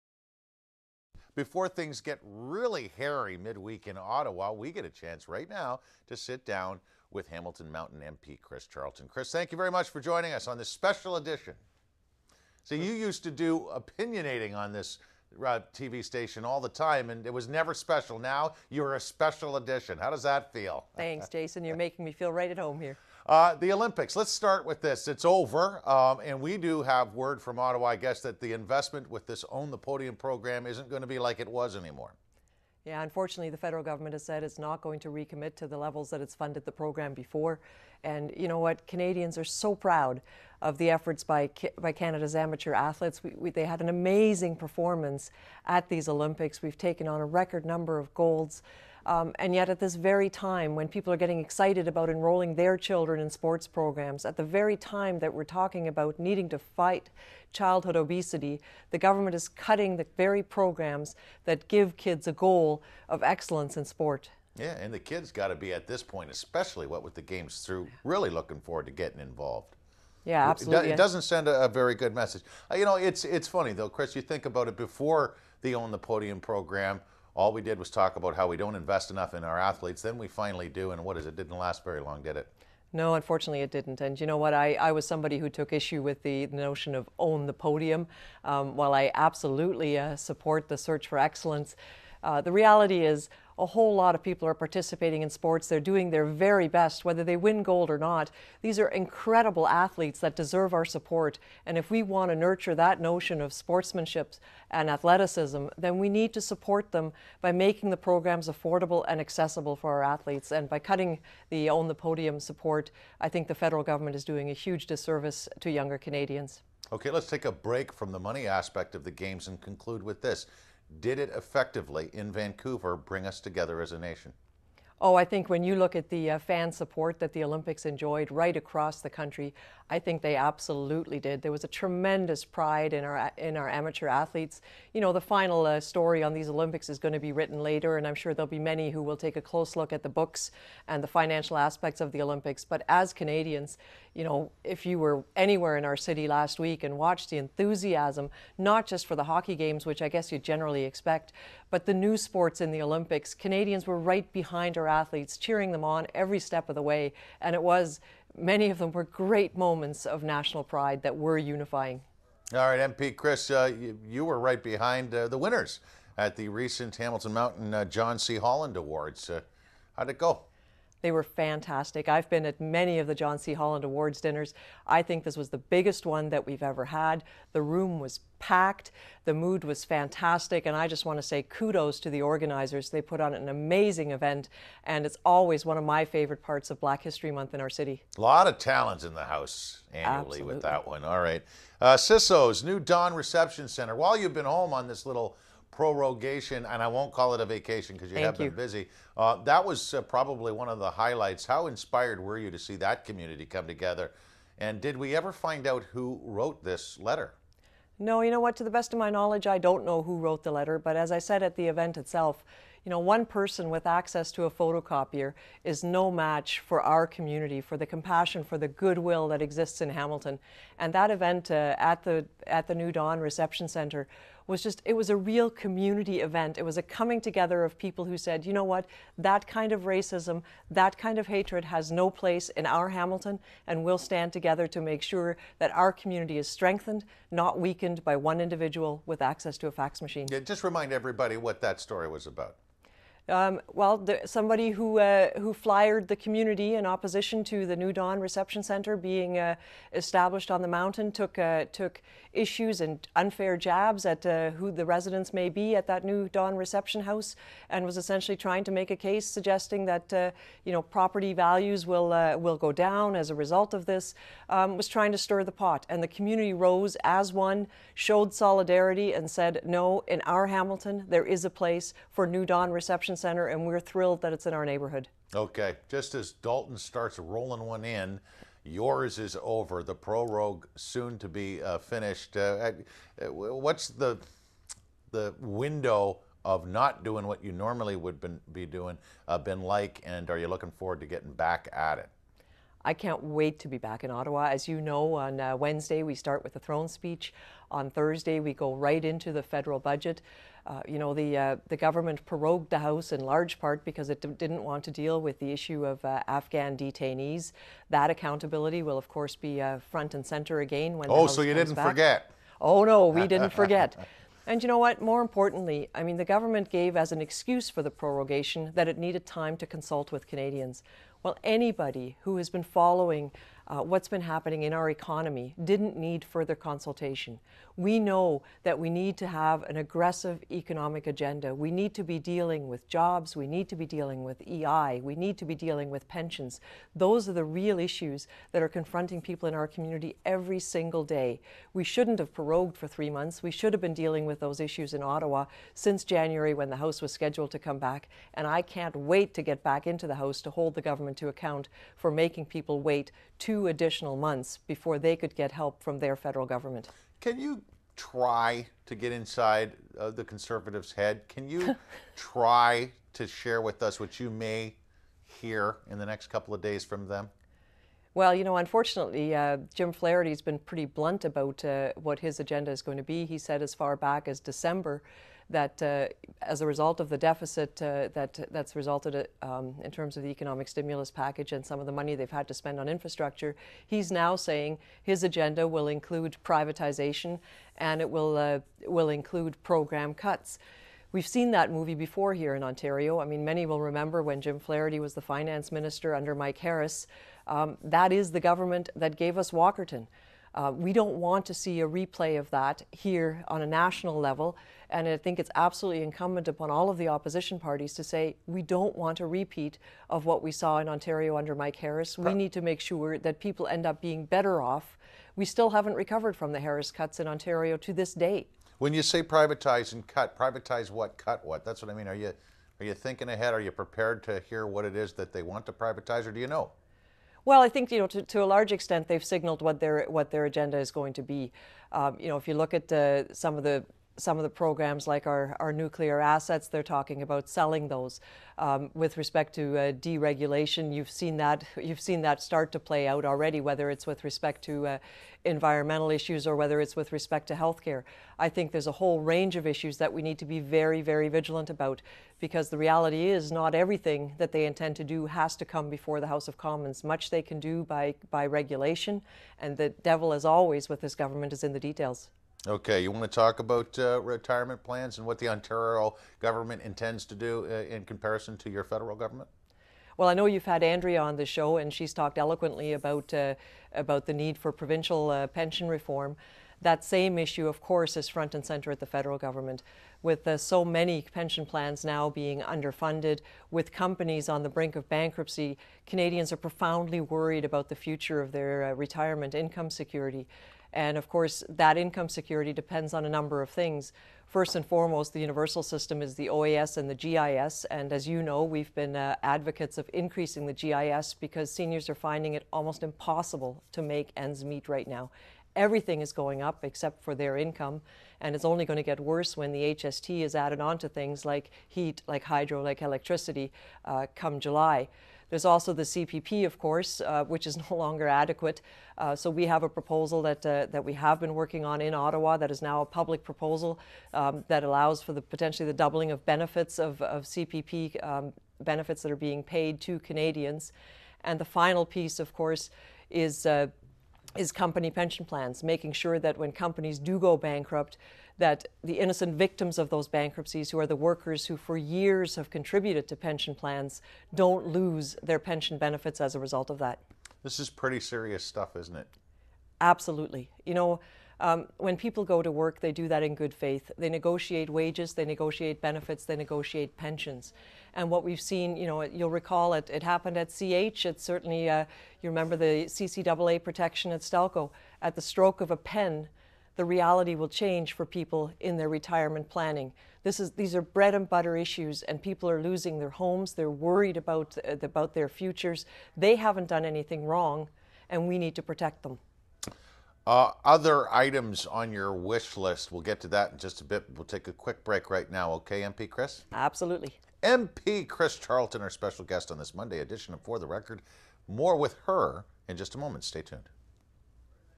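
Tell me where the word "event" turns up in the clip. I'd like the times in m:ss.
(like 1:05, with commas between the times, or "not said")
3:04, 3:31, 3:41, 3:46.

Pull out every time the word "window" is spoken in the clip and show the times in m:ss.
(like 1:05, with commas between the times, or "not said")
4:45.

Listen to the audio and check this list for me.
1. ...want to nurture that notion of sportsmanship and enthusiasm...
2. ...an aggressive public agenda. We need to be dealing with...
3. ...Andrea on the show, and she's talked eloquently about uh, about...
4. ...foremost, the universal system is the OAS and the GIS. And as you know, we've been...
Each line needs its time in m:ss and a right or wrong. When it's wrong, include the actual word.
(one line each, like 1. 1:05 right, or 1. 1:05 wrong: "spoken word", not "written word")
1. 1:42 wrong: "athleticism", not "enthusiasm"
2. 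5:29 wrong: "economic", not "public"
3. 7:50 right
4. 8:14 right.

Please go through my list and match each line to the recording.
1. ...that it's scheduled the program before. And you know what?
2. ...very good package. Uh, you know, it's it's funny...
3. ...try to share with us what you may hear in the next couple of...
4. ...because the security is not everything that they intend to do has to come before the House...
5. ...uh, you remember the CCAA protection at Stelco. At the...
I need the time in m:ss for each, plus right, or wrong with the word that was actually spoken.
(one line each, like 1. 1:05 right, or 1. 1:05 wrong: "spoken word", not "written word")
1. 0:36 wrong: "funded", not "scheduled"
2. 1:11 wrong: "message", not "package"
3. 6:02 right
4. 7:32 wrong: "reality", not "security"
5. 9:21 right.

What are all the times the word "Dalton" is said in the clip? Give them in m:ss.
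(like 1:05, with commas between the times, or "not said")
4:36.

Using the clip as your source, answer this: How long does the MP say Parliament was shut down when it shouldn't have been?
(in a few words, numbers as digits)
three months.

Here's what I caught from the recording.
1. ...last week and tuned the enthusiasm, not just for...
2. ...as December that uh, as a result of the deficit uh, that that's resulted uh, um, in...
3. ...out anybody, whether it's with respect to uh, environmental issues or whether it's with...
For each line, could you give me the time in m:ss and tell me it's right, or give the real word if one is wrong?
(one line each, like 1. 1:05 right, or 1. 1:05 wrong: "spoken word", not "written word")
1. 2:26 wrong: "watched", not "tuned"
2. 6:14 right
3. 7:23 wrong: "already", not "anybody".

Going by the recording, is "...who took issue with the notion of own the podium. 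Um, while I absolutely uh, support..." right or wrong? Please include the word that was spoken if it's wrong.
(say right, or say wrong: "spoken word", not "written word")
right.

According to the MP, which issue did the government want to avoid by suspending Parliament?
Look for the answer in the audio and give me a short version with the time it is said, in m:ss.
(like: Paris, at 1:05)
Afghan detainees, at 5:06.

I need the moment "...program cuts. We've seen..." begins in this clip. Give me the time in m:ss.
6:29.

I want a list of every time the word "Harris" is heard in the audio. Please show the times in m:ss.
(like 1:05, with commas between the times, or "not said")
6:36, 6:51, 6:56.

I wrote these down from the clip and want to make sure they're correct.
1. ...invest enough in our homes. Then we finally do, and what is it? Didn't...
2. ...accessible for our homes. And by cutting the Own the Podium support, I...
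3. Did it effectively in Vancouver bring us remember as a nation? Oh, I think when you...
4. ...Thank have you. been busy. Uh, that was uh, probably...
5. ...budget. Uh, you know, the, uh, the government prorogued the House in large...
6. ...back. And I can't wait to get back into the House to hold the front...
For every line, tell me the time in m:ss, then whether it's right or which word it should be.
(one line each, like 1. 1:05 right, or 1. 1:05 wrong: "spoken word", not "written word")
1. 1:18 wrong: "athletes", not "homes"
2. 1:49 wrong: "athletes", not "homes"
3. 2:00 wrong: "together", not "remember"
4. 3:18 right
5. 4:59 right
6. 5:47 wrong: "government", not "front".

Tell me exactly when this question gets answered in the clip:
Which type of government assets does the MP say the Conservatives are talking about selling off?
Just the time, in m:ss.
7:15.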